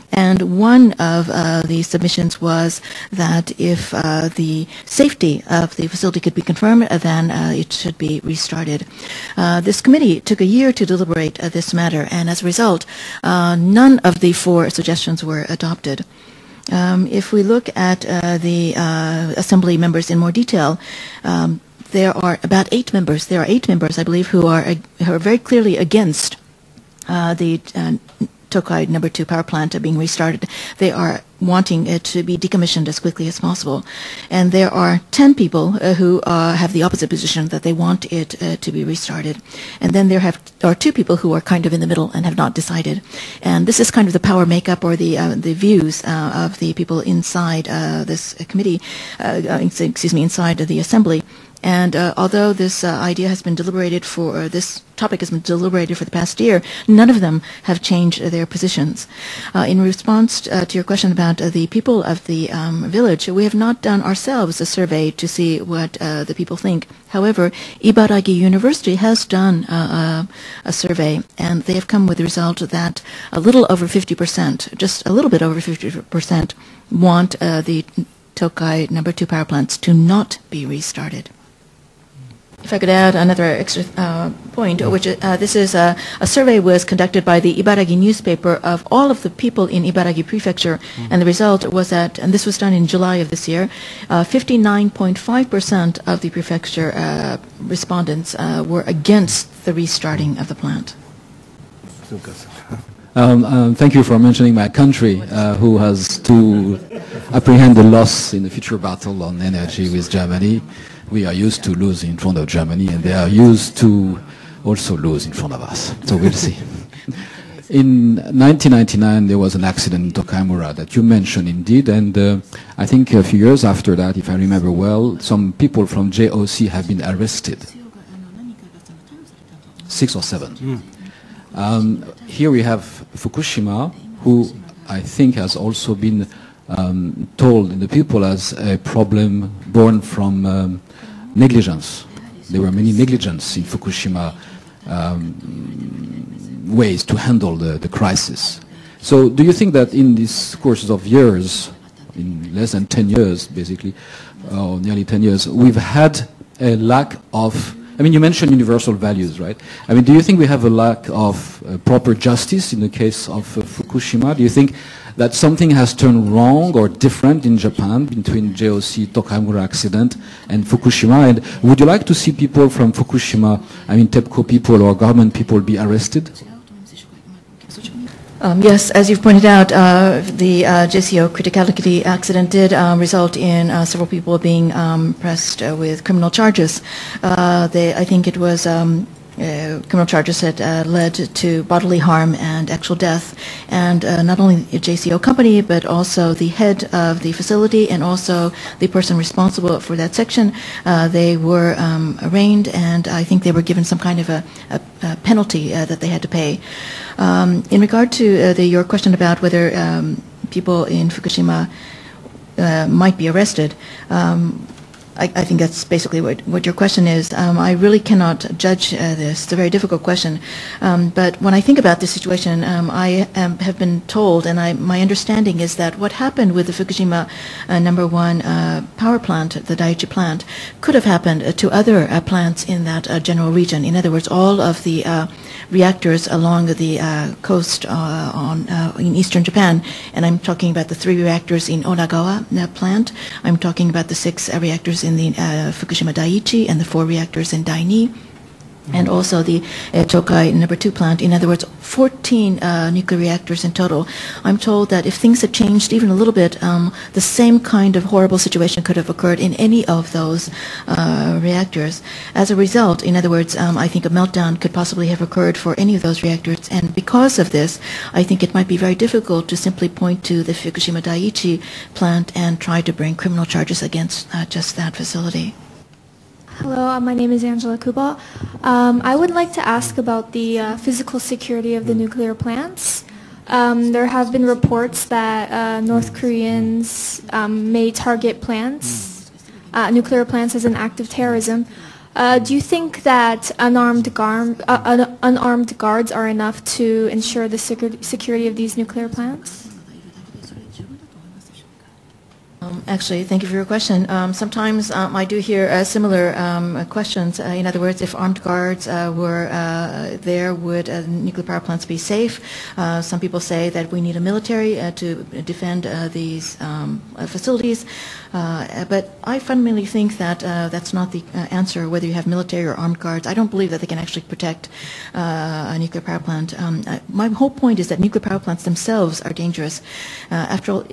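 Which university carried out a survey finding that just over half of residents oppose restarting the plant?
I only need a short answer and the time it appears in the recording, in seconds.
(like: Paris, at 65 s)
Ibaragi University, at 67 s.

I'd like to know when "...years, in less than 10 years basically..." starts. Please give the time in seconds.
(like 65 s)
151 s.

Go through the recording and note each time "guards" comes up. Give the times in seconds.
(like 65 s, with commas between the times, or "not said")
295 s, 308 s, 322 s.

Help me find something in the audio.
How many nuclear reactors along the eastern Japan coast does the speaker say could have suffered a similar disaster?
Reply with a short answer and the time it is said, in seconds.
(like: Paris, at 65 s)
14, at 251 s.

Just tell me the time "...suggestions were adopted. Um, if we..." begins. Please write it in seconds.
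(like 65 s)
14 s.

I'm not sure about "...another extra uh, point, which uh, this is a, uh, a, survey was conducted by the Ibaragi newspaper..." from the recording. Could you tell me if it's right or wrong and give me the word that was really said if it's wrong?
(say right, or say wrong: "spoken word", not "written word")
right.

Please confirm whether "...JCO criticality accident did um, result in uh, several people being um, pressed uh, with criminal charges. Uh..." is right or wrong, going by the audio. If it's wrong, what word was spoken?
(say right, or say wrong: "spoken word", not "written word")
right.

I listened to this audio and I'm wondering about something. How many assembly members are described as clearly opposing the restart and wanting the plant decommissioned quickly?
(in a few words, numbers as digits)
8.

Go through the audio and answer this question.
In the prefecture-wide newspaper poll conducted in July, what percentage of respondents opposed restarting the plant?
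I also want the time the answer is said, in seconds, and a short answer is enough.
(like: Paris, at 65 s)
59.5%, at 94 s.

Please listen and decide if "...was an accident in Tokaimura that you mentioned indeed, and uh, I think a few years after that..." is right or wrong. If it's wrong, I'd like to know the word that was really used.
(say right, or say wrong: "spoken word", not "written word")
right.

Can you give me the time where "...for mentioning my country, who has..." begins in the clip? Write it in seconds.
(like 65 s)
104 s.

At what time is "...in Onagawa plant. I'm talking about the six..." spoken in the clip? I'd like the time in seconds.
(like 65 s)
241 s.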